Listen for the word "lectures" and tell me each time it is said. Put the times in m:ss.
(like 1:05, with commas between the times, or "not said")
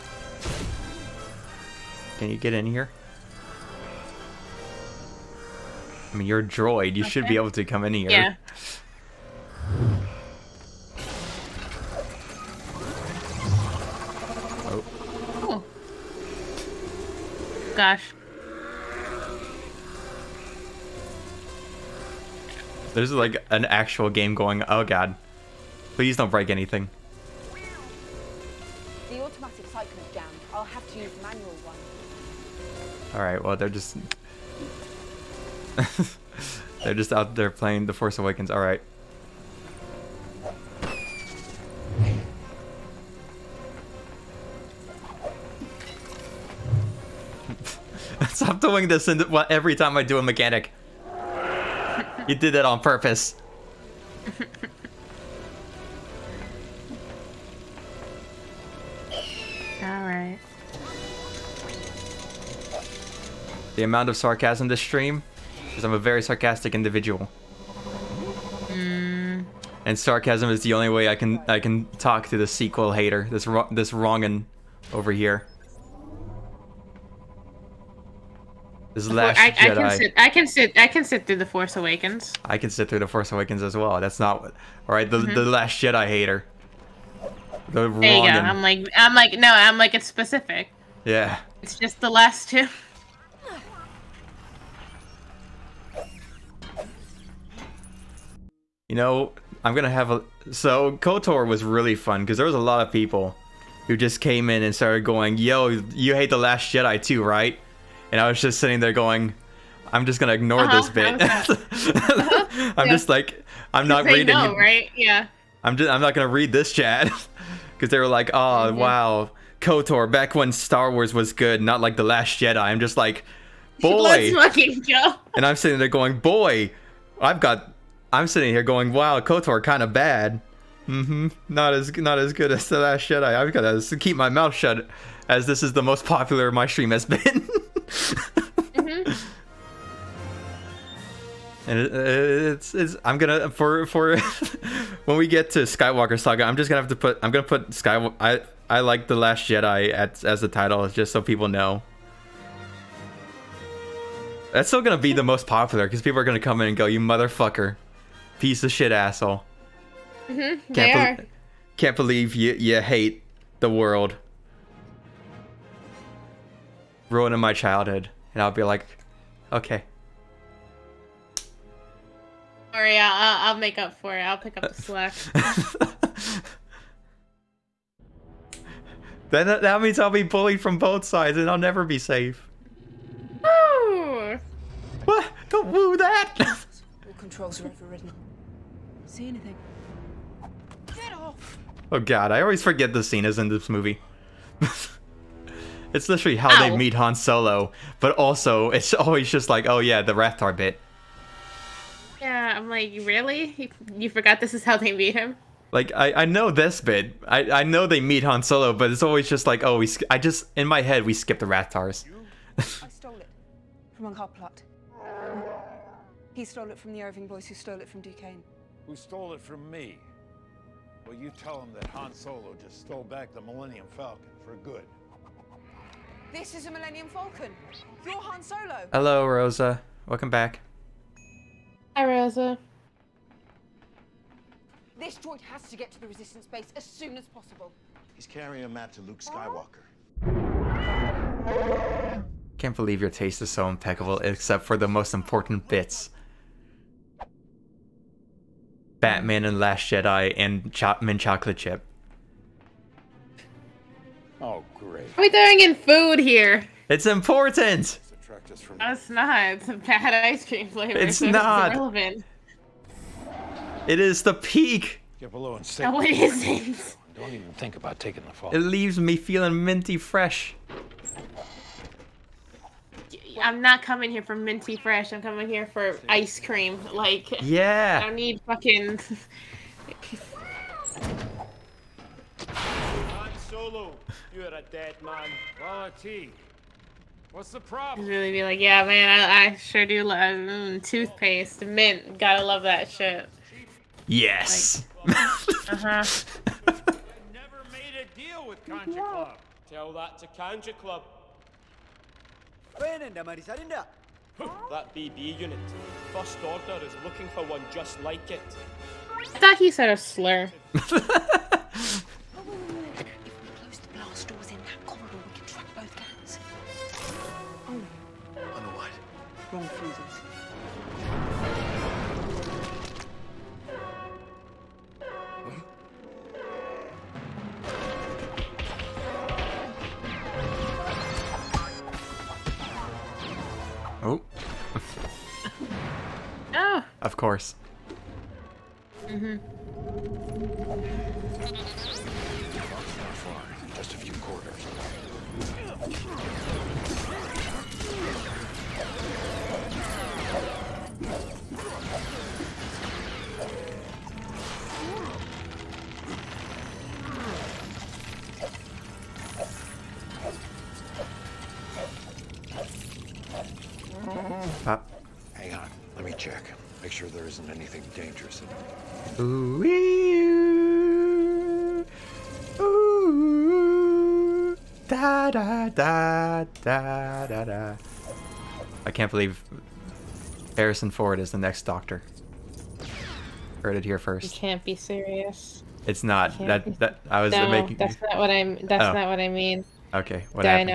not said.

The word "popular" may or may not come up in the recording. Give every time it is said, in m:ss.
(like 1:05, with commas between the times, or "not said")
2:16, 2:35.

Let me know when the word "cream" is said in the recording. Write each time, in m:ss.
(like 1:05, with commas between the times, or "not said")
4:20, 4:36.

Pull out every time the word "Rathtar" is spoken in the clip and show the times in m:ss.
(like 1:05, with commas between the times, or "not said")
3:20, 3:31.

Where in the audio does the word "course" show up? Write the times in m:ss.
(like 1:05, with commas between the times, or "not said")
5:37.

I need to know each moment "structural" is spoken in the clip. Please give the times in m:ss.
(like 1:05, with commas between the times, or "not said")
not said.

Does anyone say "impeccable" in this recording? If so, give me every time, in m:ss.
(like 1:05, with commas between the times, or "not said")
4:03.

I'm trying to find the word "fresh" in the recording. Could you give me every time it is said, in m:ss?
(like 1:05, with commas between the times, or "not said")
4:29, 4:34.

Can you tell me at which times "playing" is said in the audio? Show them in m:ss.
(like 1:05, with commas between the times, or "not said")
0:37.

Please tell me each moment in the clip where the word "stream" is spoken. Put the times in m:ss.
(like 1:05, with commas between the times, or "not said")
1:04, 2:16.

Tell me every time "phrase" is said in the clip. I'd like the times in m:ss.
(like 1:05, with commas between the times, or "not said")
not said.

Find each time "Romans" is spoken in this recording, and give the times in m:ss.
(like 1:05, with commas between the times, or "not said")
not said.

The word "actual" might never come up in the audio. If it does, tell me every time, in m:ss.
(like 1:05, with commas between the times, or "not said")
0:23.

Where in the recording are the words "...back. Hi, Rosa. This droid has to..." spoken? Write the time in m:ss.
3:50.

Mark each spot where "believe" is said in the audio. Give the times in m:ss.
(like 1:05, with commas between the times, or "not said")
2:41, 4:02, 6:19.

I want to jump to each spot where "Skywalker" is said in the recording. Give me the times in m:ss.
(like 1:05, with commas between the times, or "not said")
2:25, 3:59.